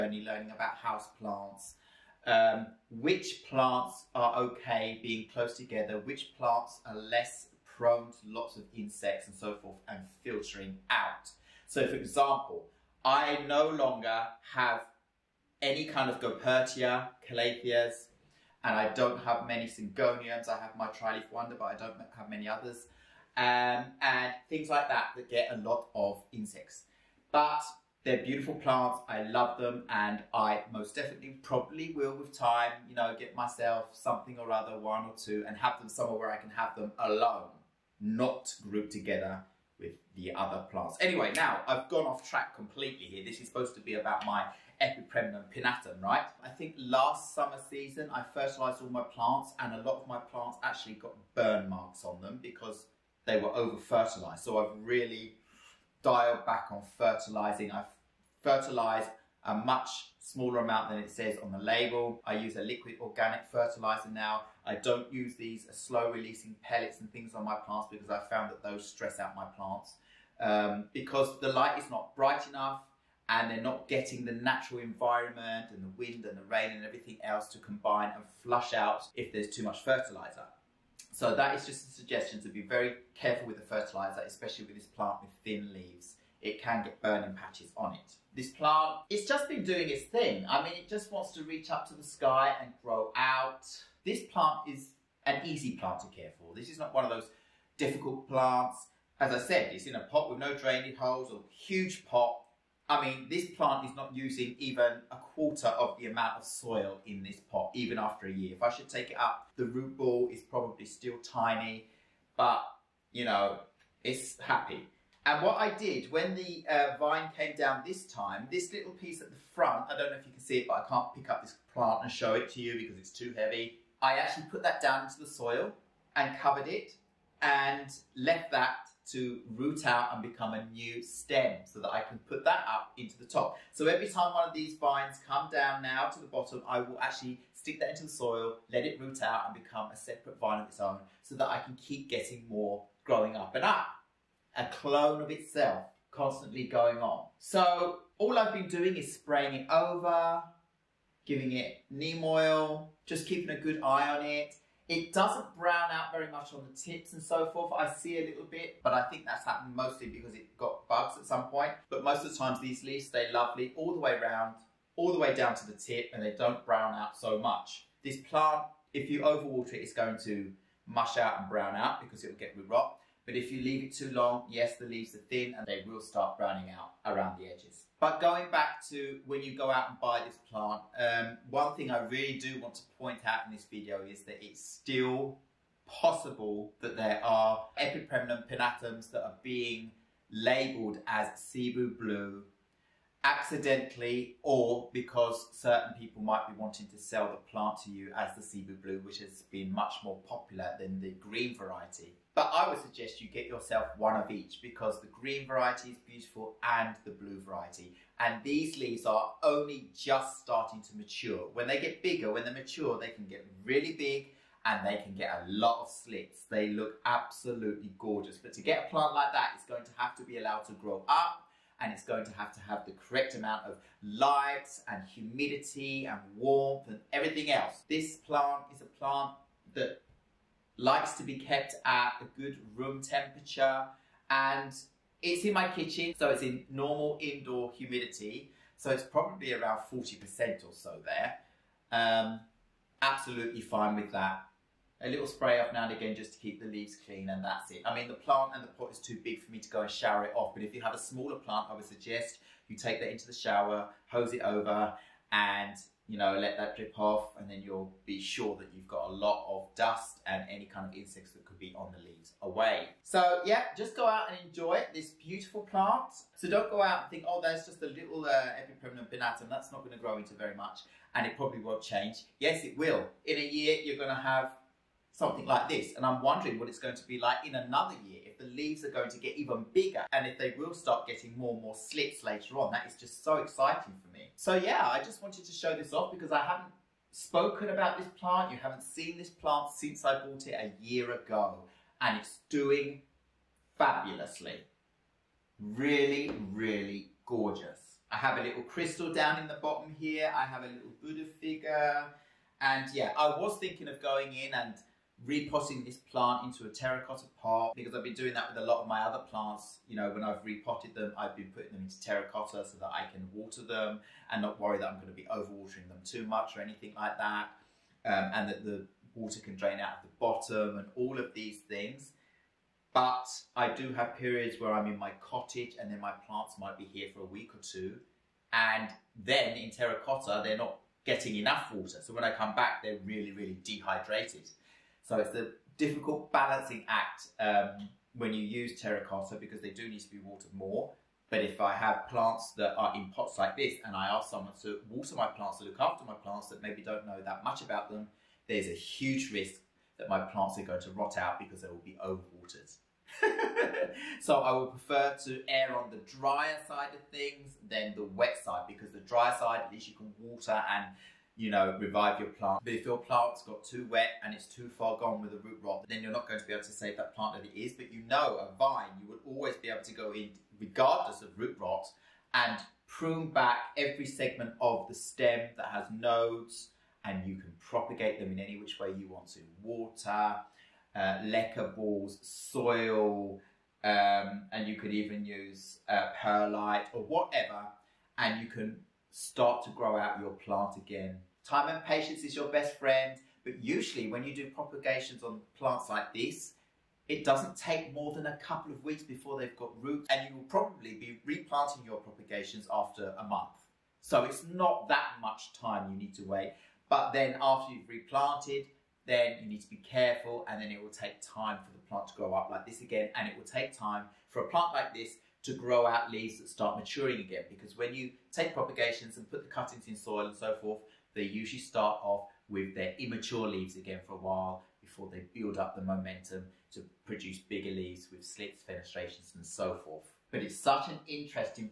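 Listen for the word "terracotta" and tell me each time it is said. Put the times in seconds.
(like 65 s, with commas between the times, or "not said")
306 s, 312 s, 329 s, 338 s.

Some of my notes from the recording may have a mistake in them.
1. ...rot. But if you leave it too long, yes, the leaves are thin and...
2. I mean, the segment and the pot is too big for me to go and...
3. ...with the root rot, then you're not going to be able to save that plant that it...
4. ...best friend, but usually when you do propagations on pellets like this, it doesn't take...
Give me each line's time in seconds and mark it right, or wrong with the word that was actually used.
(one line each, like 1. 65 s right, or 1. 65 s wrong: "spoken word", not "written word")
1. 172 s right
2. 247 s wrong: "plant", not "segment"
3. 365 s right
4. 392 s wrong: "plants", not "pellets".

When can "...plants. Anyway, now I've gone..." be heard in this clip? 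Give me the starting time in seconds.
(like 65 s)
40 s.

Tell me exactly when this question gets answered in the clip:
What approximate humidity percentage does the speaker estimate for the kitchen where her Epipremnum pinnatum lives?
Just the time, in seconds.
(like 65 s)
239 s.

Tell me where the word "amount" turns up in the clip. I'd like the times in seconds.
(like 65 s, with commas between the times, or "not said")
60 s, 106 s, 223 s.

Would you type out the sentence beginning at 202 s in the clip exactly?
But I would suggest you get yourself one of each because the green variety is beautiful and the blue variety.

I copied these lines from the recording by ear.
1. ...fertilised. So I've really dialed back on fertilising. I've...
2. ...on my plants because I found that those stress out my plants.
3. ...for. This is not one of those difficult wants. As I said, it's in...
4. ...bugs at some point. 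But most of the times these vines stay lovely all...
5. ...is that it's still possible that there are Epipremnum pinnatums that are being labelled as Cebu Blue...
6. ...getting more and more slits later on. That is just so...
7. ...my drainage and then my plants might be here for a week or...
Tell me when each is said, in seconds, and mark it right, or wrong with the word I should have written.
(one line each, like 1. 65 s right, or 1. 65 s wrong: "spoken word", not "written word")
1. 53 s right
2. 67 s right
3. 96 s wrong: "plants", not "wants"
4. 160 s wrong: "leaves", not "vines"
5. 184 s right
6. 281 s right
7. 324 s wrong: "cottage", not "drainage".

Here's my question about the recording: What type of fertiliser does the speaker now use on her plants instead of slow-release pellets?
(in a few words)
Liquid organic fertilizer.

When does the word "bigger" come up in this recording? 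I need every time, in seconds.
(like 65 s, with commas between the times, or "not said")
212 s, 279 s, 427 s.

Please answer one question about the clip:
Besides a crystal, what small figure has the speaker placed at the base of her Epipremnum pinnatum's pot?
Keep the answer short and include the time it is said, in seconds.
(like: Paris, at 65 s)
Buddha figure, at 301 s.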